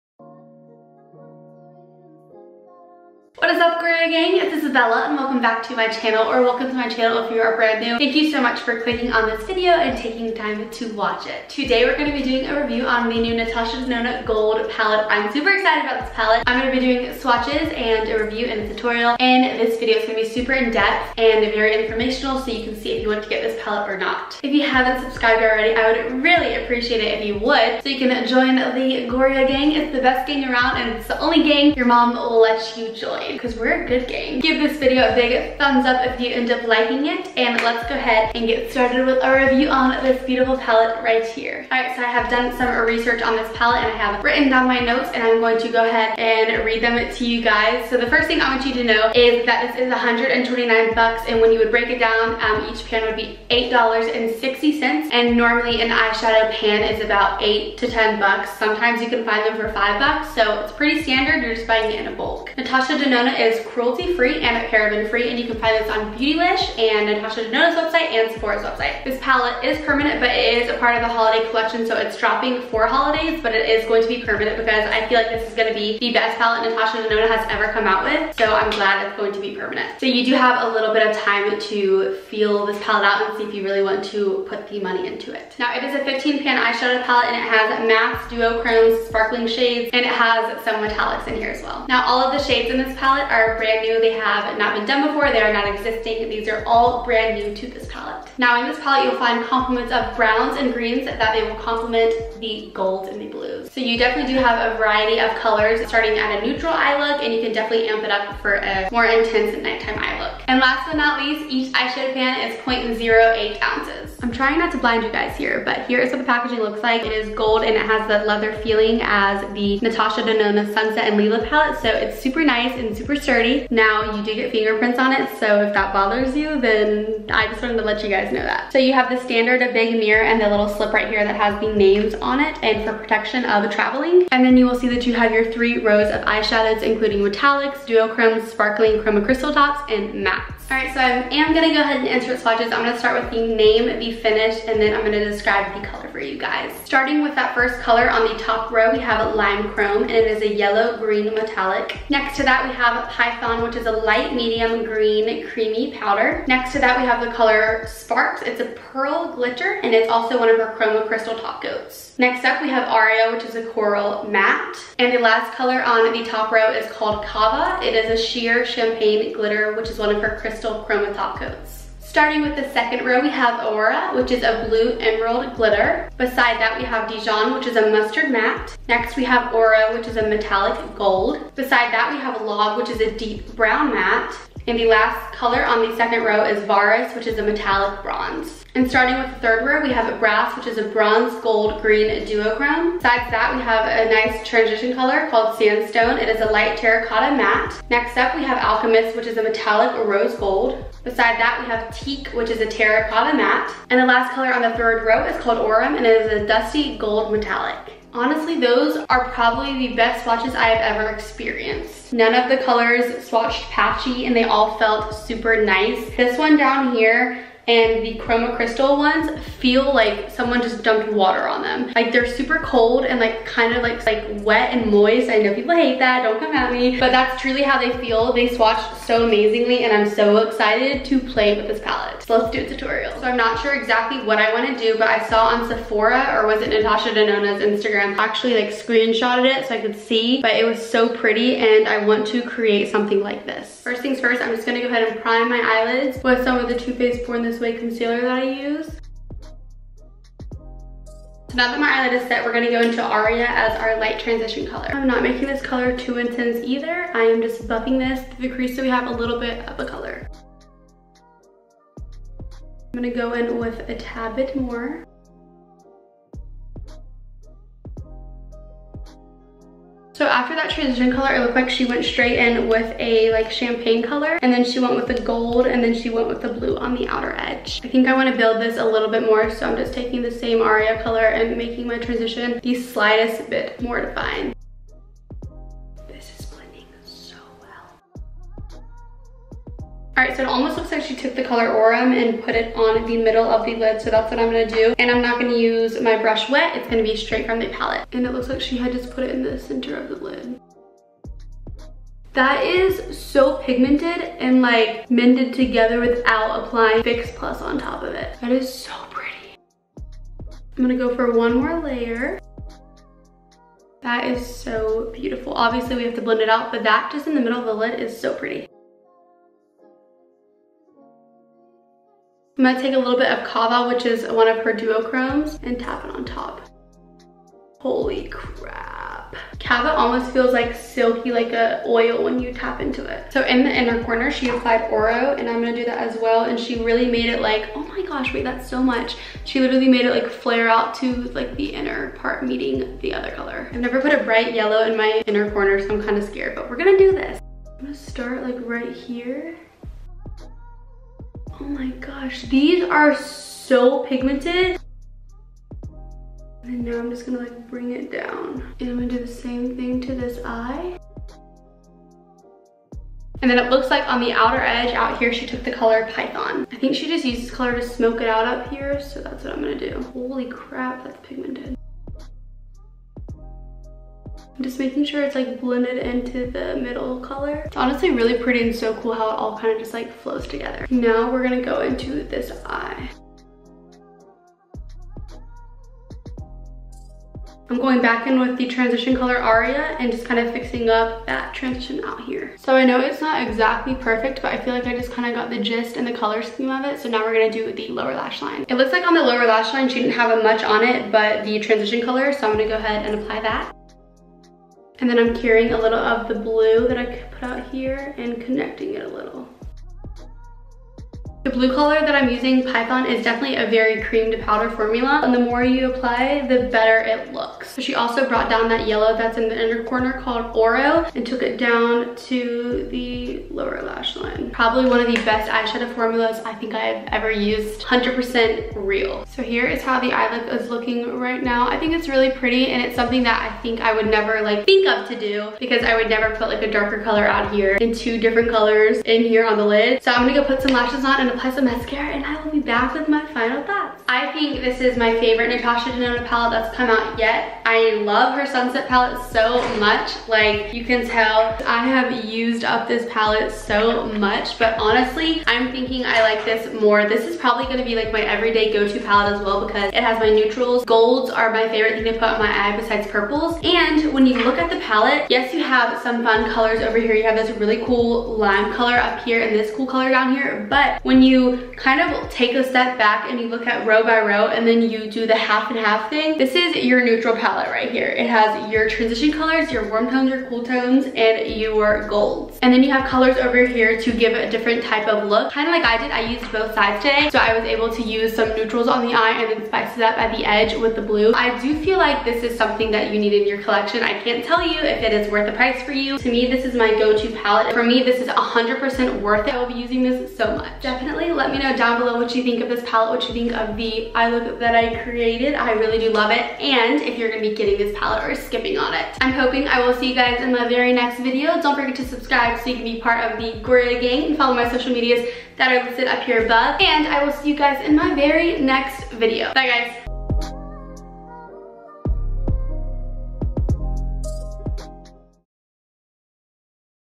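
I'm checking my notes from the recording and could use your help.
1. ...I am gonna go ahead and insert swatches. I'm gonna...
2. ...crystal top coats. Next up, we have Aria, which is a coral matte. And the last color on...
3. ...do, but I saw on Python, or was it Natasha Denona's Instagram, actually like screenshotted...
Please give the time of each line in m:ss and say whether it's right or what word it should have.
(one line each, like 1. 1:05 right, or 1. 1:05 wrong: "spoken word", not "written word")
1. 2:21 right
2. 2:41 right
3. 3:54 wrong: "Sephora", not "Python".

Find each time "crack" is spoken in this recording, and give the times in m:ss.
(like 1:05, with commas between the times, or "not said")
not said.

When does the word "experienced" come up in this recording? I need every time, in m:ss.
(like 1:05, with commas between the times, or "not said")
3:31.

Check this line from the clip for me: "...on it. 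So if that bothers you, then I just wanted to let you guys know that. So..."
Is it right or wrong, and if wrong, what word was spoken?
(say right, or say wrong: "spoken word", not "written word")
right.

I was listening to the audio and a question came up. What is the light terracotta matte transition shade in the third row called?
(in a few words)
Sandstone.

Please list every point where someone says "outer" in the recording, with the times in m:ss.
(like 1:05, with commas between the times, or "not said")
4:37, 6:04.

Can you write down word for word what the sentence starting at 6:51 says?
The blue color that I'm using, Python, is definitely a very cream to powder formula.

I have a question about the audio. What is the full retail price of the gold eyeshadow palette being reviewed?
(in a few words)
$129.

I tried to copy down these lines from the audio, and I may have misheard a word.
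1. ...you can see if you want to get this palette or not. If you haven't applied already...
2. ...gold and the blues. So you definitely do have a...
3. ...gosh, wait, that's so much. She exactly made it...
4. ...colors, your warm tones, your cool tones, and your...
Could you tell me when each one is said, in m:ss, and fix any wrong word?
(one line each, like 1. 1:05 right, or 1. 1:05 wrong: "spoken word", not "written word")
1. 0:22 wrong: "subscribed", not "applied"
2. 1:42 right
3. 5:38 wrong: "literally", not "exactly"
4. 7:59 right.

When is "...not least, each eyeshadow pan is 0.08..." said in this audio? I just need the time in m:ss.
1:50.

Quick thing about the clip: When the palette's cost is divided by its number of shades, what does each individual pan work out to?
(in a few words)
$8.60.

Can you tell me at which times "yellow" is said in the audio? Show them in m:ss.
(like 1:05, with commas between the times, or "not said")
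2:30, 5:44, 6:58.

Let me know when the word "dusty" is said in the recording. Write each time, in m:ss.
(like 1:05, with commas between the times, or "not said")
3:26.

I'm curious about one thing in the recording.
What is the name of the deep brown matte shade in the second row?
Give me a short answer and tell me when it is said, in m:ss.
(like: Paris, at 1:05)
Log, at 3:02.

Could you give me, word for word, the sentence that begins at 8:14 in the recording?
I can't tell you if it is worth the price for you.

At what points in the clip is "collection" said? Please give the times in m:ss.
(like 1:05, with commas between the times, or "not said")
1:11, 8:13.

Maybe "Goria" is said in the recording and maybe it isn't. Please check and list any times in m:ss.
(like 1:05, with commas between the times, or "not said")
0:03, 0:29, 8:33.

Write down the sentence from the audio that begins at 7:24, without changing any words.
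I think this is my favorite Natasha Denona palette that's come out yet.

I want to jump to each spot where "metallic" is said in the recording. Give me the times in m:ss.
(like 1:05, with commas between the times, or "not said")
1:30, 2:17, 2:31, 3:00, 3:07, 3:19, 3:27.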